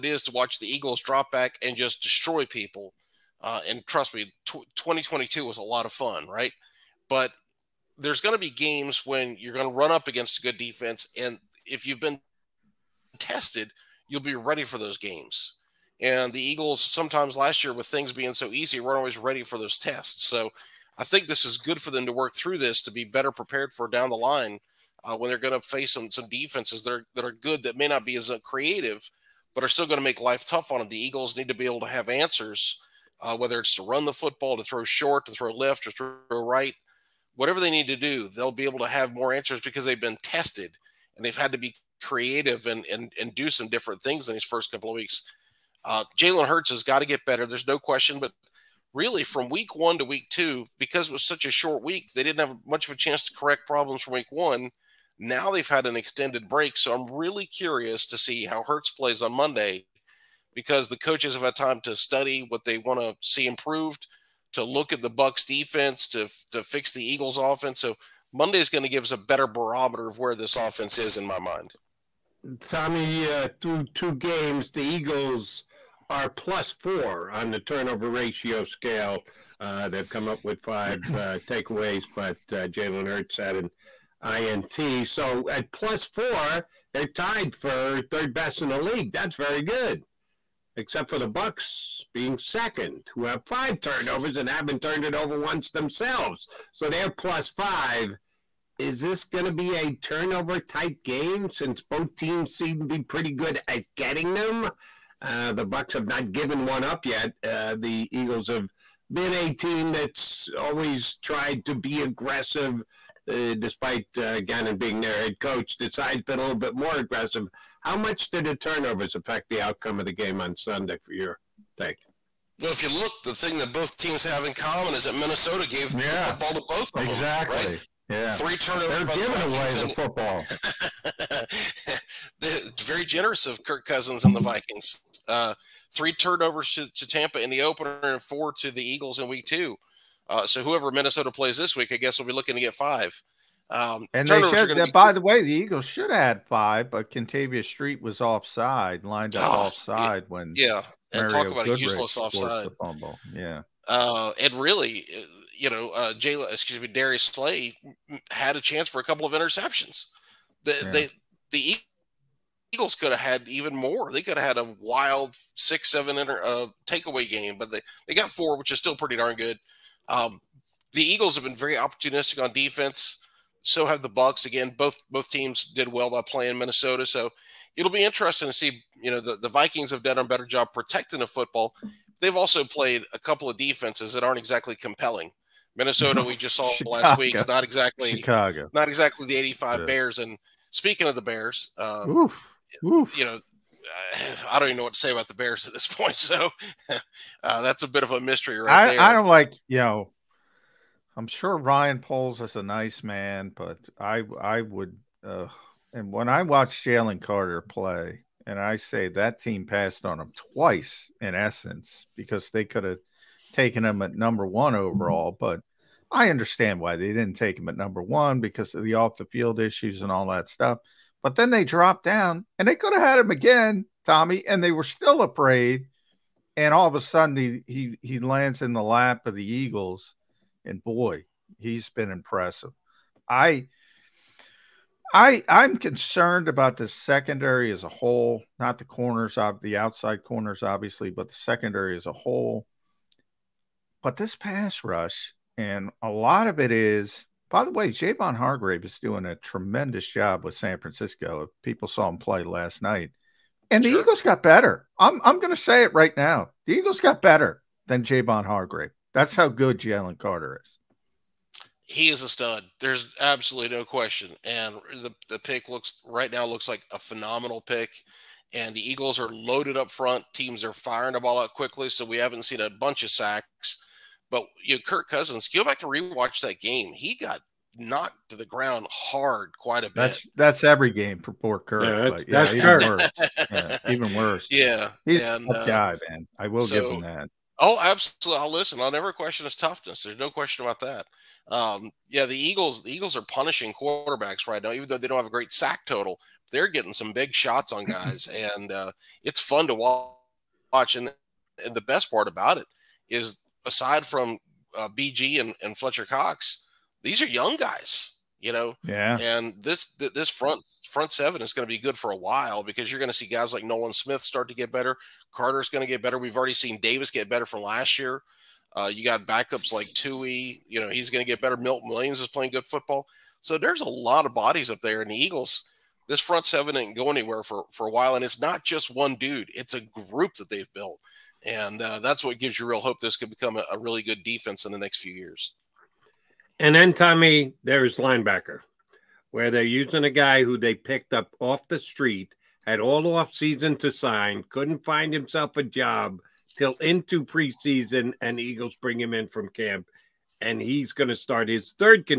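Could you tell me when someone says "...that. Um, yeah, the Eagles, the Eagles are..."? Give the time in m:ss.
4:50.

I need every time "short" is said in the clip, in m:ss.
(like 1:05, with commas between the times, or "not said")
0:34, 0:51.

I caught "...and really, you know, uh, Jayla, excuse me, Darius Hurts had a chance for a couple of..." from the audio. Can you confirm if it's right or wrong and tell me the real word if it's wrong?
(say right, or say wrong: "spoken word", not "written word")
wrong: "Slay", not "Hurts".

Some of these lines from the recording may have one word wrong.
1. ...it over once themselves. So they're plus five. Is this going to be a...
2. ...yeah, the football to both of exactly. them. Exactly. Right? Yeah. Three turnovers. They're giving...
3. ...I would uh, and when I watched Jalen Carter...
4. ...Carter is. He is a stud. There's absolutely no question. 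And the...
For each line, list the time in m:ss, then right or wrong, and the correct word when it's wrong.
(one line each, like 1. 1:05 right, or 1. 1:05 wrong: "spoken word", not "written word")
1. 1:35 right
2. 2:05 right
3. 3:24 right
4. 4:20 right.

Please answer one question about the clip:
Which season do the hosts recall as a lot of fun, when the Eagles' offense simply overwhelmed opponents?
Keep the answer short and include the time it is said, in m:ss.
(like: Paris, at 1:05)
2022, at 0:04.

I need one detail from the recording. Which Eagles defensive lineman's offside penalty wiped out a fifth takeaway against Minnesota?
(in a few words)
Kentavius Street.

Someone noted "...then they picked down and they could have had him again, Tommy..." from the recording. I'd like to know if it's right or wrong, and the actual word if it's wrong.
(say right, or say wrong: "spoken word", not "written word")
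wrong: "dropped", not "picked".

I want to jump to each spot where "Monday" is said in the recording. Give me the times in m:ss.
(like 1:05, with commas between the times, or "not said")
0:59, 1:08.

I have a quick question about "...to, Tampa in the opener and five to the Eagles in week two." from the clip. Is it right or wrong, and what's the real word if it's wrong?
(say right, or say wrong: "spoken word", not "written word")
wrong: "four", not "five".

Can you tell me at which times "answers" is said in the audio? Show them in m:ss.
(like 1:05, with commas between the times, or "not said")
0:32, 0:39.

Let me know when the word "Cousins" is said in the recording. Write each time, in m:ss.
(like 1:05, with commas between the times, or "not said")
2:13, 4:35.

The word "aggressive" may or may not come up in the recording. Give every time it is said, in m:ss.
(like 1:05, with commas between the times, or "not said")
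1:52, 1:56.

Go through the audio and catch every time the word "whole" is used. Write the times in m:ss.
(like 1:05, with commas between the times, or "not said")
3:57, 4:02.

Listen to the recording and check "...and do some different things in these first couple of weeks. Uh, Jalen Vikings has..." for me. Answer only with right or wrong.
wrong.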